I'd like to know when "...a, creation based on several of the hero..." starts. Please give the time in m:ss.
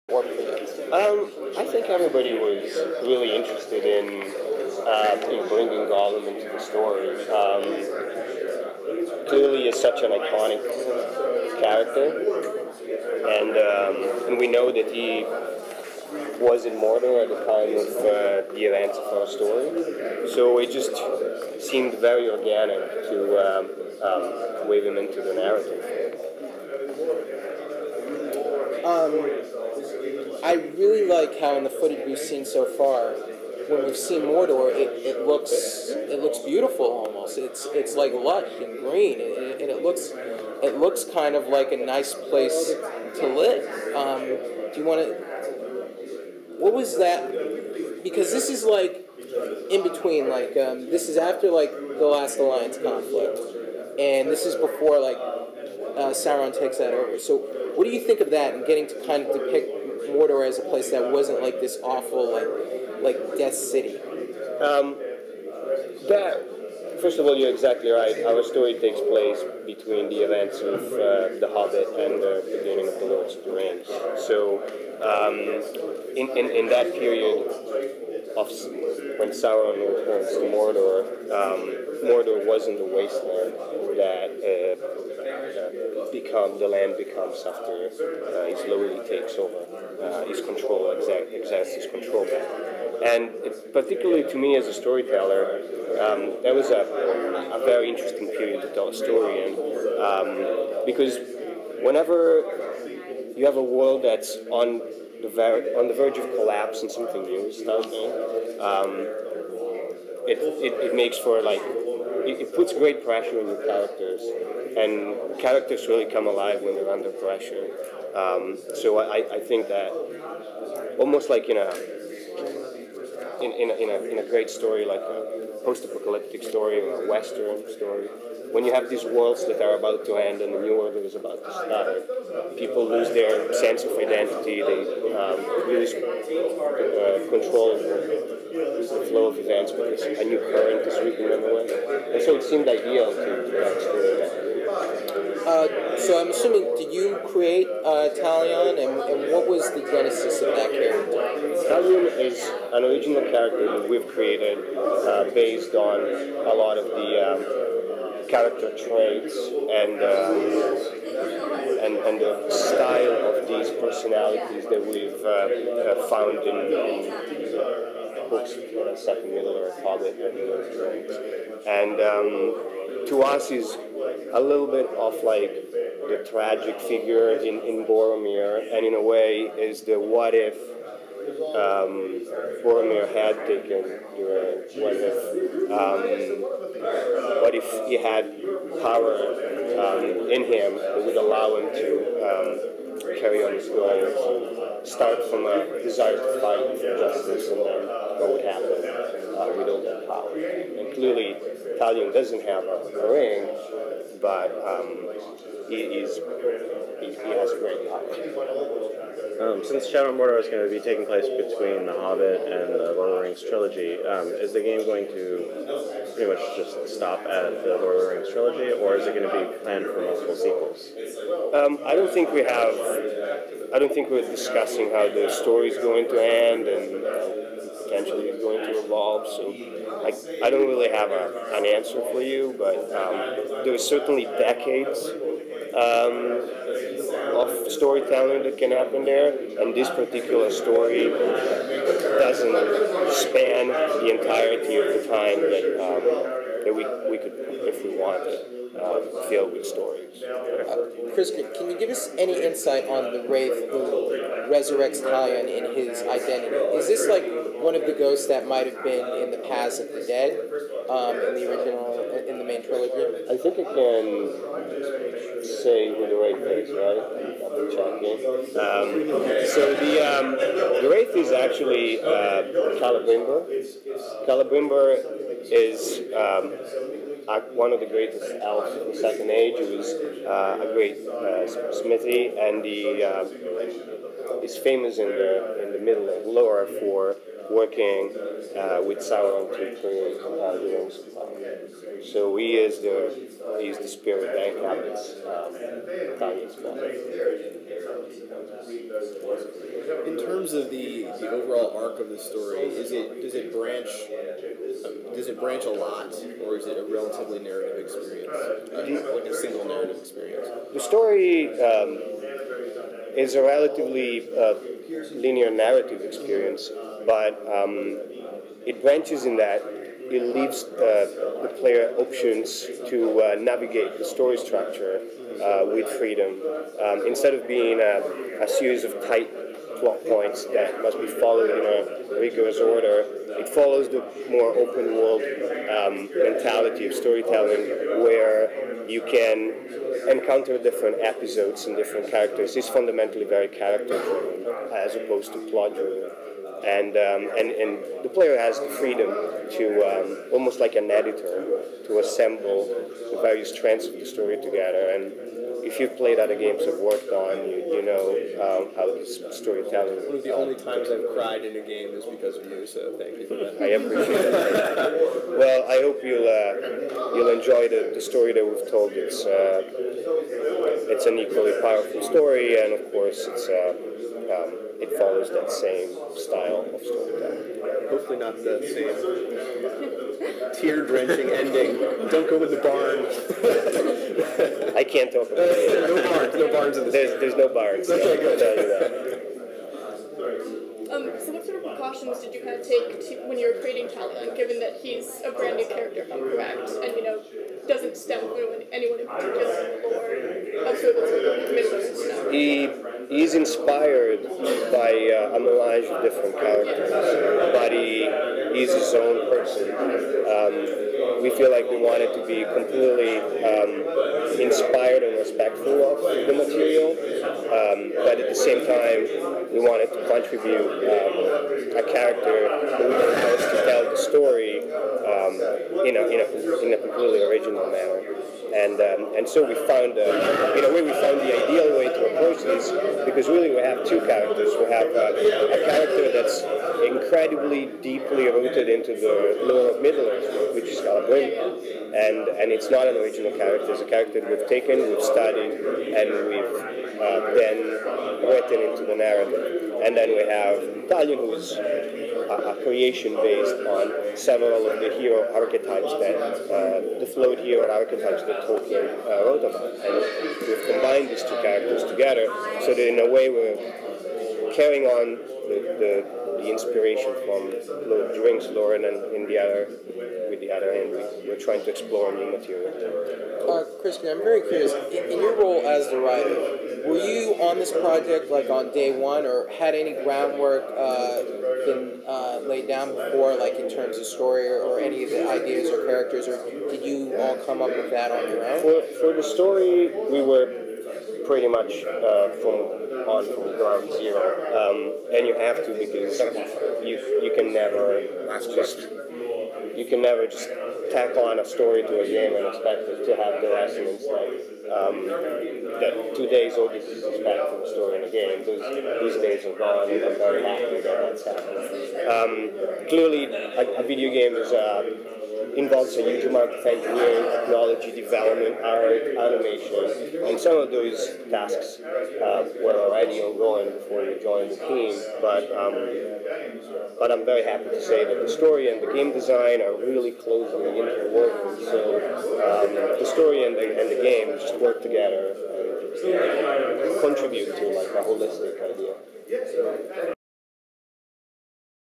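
7:32.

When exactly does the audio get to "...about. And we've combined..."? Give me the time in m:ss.
7:39.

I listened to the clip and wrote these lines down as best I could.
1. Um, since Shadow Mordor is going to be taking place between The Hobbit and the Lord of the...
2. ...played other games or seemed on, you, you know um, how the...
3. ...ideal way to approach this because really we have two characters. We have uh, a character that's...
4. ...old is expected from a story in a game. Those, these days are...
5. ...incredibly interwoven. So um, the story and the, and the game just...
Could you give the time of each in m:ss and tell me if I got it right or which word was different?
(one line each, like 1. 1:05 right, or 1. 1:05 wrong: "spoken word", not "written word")
1. 3:29 right
2. 5:55 wrong: "worked", not "seemed"
3. 7:11 right
4. 8:26 right
5. 8:50 wrong: "closely", not "incredibly".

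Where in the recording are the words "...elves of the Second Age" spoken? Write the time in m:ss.
4:38.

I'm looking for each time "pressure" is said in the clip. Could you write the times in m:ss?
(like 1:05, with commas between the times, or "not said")
1:53, 1:57.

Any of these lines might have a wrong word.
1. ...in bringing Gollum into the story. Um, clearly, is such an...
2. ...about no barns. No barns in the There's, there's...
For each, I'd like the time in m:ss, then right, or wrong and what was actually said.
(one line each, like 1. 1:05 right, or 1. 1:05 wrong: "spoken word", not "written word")
1. 0:05 right
2. 6:25 right.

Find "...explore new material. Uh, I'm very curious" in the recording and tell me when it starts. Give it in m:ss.
7:51.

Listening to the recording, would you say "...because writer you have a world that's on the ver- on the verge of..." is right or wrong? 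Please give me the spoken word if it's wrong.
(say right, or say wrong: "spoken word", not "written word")
wrong: "whenever", not "writer".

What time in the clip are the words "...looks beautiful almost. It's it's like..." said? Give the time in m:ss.
0:36.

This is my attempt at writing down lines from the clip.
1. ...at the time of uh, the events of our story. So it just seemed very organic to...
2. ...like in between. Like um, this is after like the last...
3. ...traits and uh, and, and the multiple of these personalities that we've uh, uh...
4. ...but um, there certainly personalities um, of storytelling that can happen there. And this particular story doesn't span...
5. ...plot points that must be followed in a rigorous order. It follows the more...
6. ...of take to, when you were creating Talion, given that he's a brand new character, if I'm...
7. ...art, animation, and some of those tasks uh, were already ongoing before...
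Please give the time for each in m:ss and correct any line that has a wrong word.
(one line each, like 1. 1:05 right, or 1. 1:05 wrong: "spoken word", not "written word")
1. 0:17 right
2. 0:48 right
3. 2:38 wrong: "style", not "multiple"
4. 3:52 wrong: "decades", not "personalities"
5. 5:29 right
6. 6:32 right
7. 8:38 right.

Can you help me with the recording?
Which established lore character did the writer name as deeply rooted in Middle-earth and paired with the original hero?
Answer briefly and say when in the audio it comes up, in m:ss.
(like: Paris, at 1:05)
Galadriel, at 7:20.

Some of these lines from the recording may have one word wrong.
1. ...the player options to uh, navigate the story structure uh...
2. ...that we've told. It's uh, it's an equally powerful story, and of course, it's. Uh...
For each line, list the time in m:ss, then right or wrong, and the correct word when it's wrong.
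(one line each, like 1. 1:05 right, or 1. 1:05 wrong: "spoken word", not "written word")
1. 5:21 right
2. 6:08 right.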